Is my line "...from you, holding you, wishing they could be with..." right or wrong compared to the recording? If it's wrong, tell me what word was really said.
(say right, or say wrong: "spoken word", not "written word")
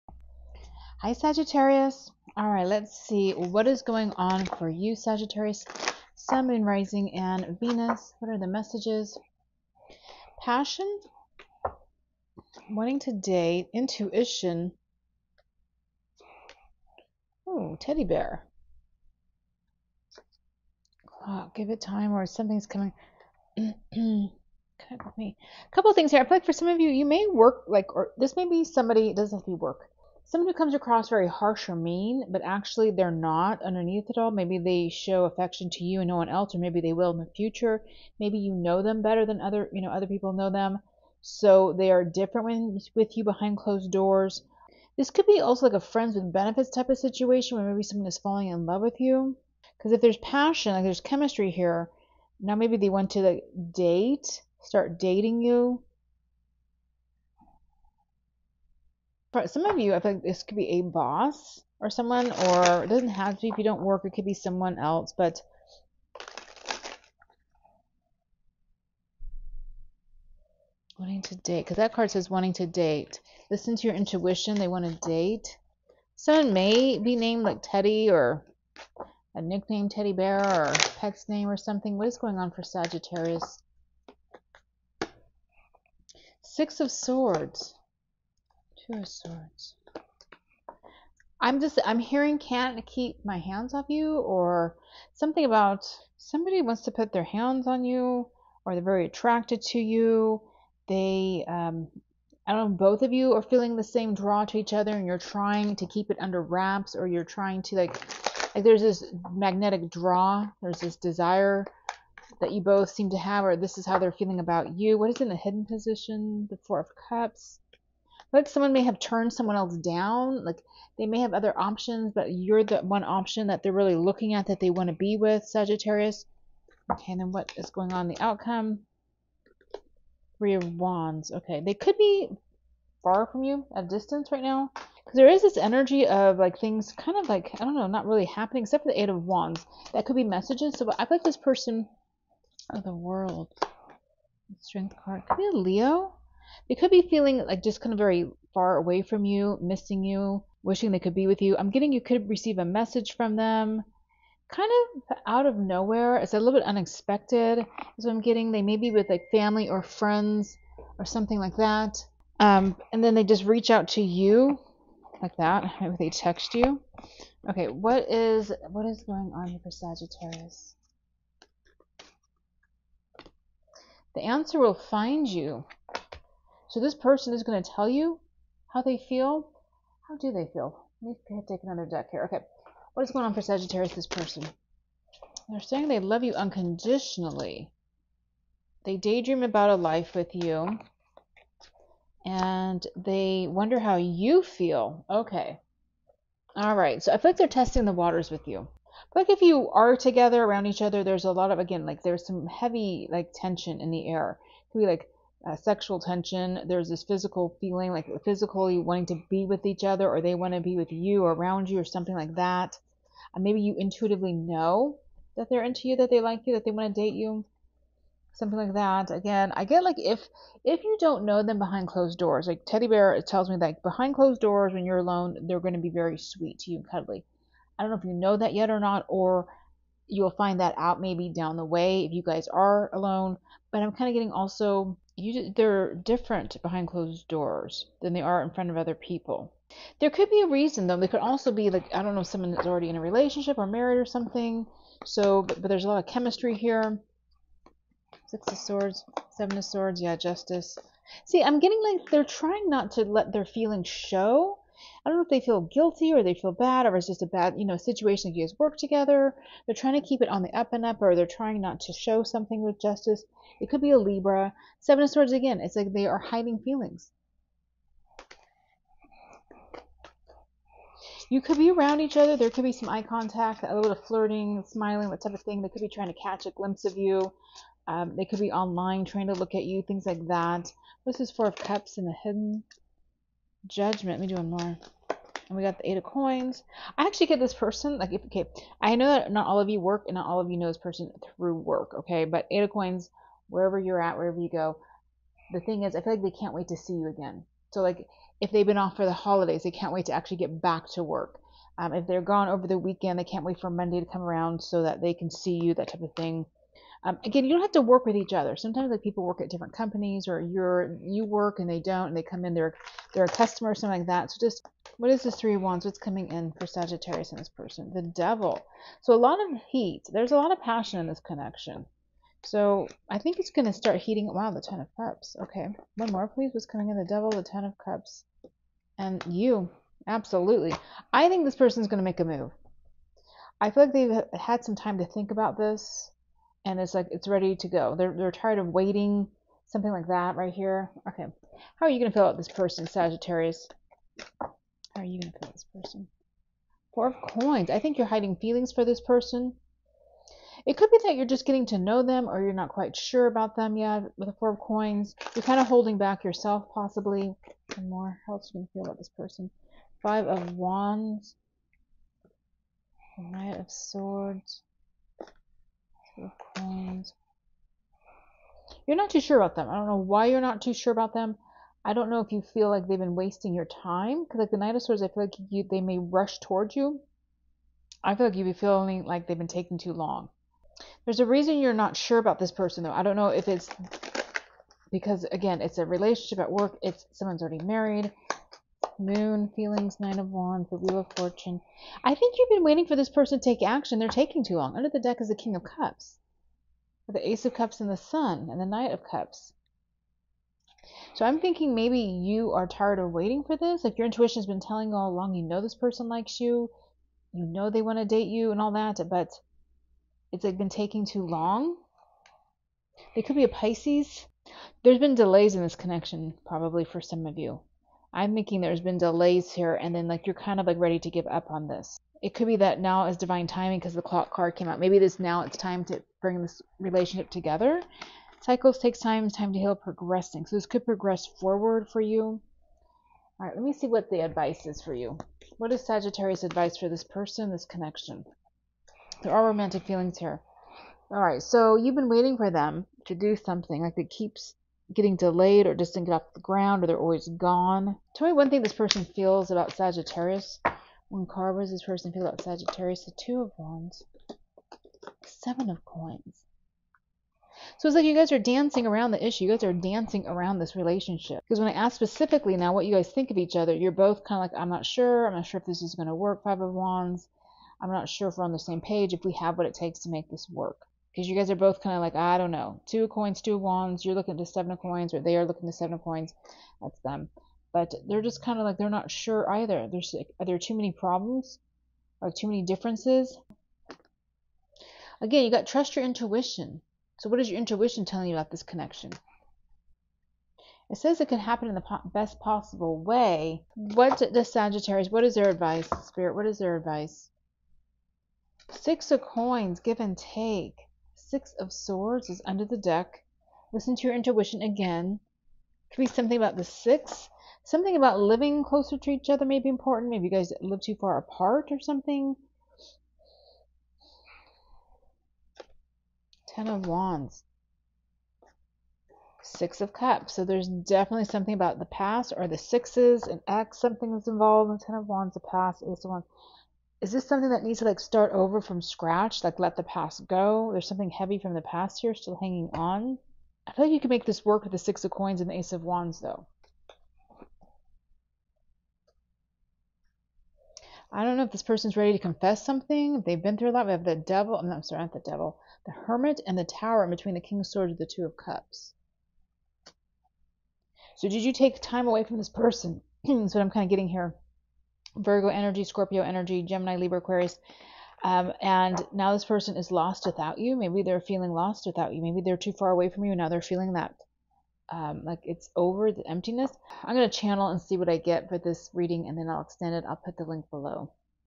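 wrong: "missing", not "holding".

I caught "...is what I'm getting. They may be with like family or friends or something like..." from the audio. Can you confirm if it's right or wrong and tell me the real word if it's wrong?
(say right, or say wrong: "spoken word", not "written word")
right.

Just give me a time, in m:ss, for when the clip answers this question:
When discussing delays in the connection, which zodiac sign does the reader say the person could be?
6:53.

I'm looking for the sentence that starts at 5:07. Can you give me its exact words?
Um, again, you don't have to work with each other.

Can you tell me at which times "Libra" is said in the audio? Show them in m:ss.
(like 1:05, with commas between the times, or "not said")
4:23, 9:16.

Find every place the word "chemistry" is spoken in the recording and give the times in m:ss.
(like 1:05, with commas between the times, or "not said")
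0:51, 4:06.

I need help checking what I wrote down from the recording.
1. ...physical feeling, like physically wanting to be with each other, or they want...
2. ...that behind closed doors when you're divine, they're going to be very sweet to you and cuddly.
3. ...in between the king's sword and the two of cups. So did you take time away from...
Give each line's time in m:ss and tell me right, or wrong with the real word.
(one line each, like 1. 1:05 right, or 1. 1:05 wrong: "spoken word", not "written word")
1. 3:27 right
2. 3:43 wrong: "alone", not "divine"
3. 9:07 right.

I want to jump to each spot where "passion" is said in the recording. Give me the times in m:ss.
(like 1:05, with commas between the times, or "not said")
0:10, 0:50, 5:20.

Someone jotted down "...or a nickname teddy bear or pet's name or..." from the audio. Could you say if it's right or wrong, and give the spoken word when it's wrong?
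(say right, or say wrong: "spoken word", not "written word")
right.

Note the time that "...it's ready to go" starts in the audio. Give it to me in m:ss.
5:37.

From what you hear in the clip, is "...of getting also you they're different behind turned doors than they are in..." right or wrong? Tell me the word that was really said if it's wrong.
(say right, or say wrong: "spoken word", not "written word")
wrong: "closed", not "turned".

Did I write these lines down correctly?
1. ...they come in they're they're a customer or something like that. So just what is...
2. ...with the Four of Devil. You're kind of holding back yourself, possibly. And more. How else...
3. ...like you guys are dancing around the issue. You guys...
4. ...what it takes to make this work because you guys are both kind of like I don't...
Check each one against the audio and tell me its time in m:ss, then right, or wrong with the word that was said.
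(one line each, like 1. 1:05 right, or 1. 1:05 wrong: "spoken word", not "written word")
1. 5:12 right
2. 5:54 wrong: "Coins", not "Devil"
3. 7:37 right
4. 7:49 right.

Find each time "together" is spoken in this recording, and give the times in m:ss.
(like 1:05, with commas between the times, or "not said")
3:19, 4:18, 7:07.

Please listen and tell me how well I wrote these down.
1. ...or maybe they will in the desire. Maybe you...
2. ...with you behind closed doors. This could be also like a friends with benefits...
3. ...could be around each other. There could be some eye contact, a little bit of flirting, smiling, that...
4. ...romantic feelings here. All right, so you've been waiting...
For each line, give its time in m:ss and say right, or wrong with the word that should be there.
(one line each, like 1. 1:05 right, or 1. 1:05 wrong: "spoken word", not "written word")
1. 0:36 wrong: "future", not "desire"
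2. 0:42 right
3. 4:31 right
4. 7:19 right.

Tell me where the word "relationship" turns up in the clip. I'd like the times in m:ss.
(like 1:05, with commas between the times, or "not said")
4:03, 6:25, 7:06, 7:40.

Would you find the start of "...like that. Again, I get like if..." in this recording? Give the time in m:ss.
3:38.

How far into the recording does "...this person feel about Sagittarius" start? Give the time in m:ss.
7:31.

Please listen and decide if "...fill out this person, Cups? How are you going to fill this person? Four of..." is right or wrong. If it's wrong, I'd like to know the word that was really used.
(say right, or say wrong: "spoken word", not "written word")
wrong: "Sagittarius", not "Cups".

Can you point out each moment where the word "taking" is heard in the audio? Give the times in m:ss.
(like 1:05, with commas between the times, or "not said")
6:19, 6:34, 6:50.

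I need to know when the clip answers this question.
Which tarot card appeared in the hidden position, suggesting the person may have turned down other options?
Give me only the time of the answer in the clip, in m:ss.
1:56.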